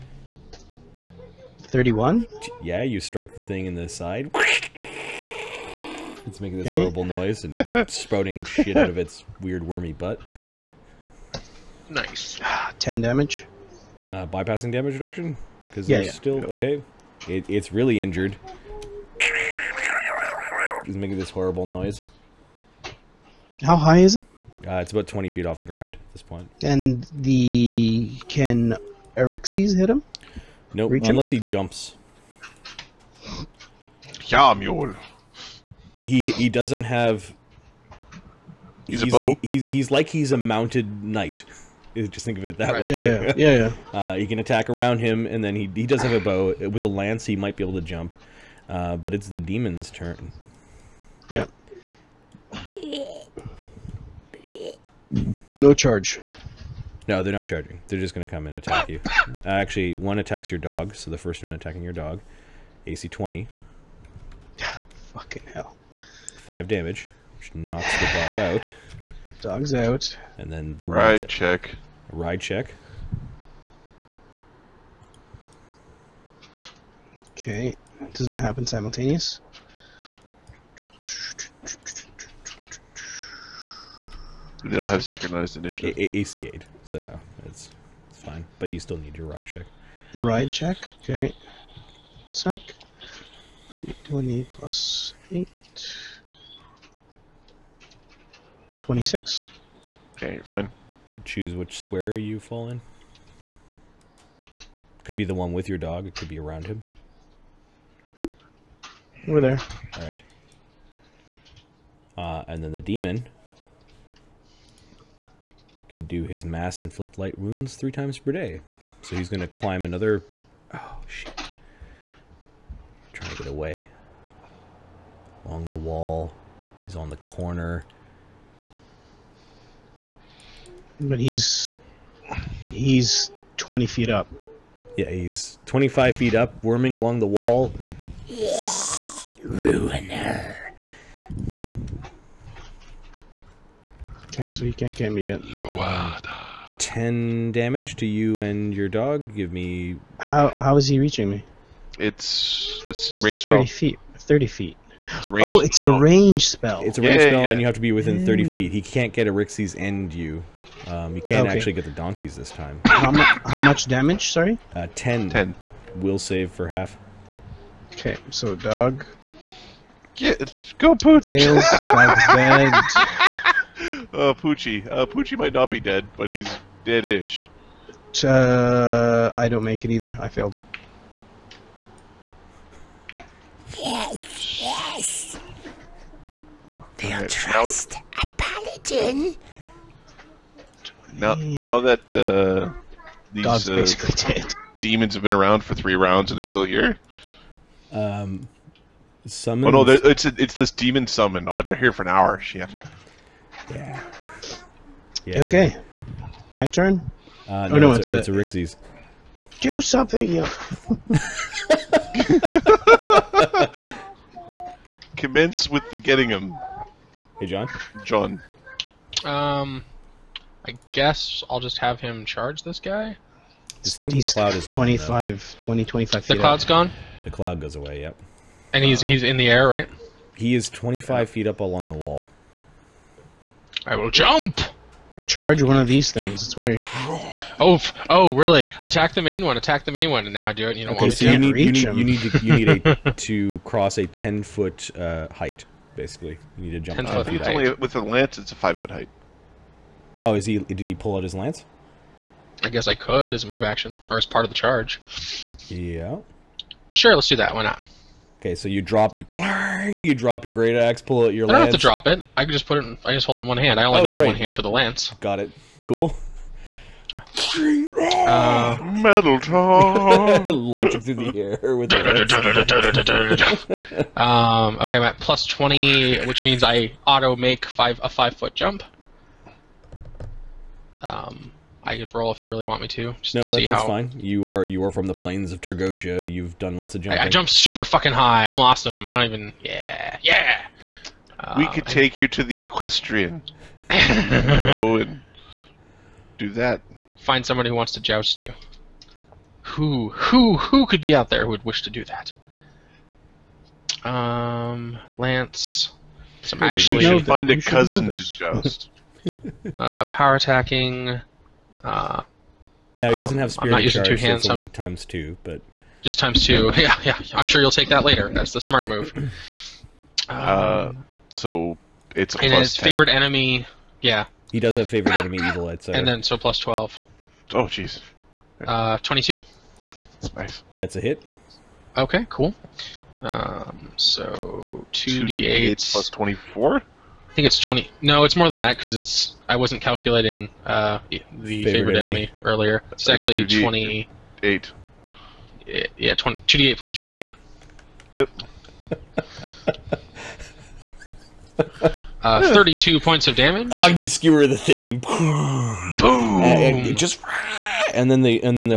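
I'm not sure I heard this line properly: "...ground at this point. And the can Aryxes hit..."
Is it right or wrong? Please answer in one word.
right.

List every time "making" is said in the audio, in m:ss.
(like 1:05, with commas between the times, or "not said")
0:06, 0:20.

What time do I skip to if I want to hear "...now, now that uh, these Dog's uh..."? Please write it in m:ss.
3:11.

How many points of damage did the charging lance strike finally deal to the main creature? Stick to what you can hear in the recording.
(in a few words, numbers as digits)
32.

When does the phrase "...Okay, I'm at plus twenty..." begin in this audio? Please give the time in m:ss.
4:34.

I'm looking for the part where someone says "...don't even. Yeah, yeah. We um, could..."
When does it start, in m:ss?
4:49.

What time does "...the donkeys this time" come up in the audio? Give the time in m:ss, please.
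2:41.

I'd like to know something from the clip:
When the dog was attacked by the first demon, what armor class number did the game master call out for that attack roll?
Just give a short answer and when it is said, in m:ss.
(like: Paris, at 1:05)
20, at 1:02.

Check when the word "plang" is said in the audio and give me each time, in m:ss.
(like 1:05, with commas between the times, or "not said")
4:19.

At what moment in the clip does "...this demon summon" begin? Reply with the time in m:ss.
3:20.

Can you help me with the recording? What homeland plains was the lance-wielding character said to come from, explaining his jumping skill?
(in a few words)
Targosia.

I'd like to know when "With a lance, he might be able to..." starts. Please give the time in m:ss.
0:46.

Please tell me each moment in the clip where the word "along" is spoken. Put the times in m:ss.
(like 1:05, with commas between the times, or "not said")
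2:05, 2:16, 3:51.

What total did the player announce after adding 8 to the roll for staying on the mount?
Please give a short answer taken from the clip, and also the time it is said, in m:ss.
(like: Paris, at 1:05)
26, at 1:38.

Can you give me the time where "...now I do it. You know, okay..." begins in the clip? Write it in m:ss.
4:00.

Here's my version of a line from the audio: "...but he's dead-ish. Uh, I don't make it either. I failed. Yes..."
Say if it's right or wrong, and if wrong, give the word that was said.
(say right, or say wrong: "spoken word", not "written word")
right.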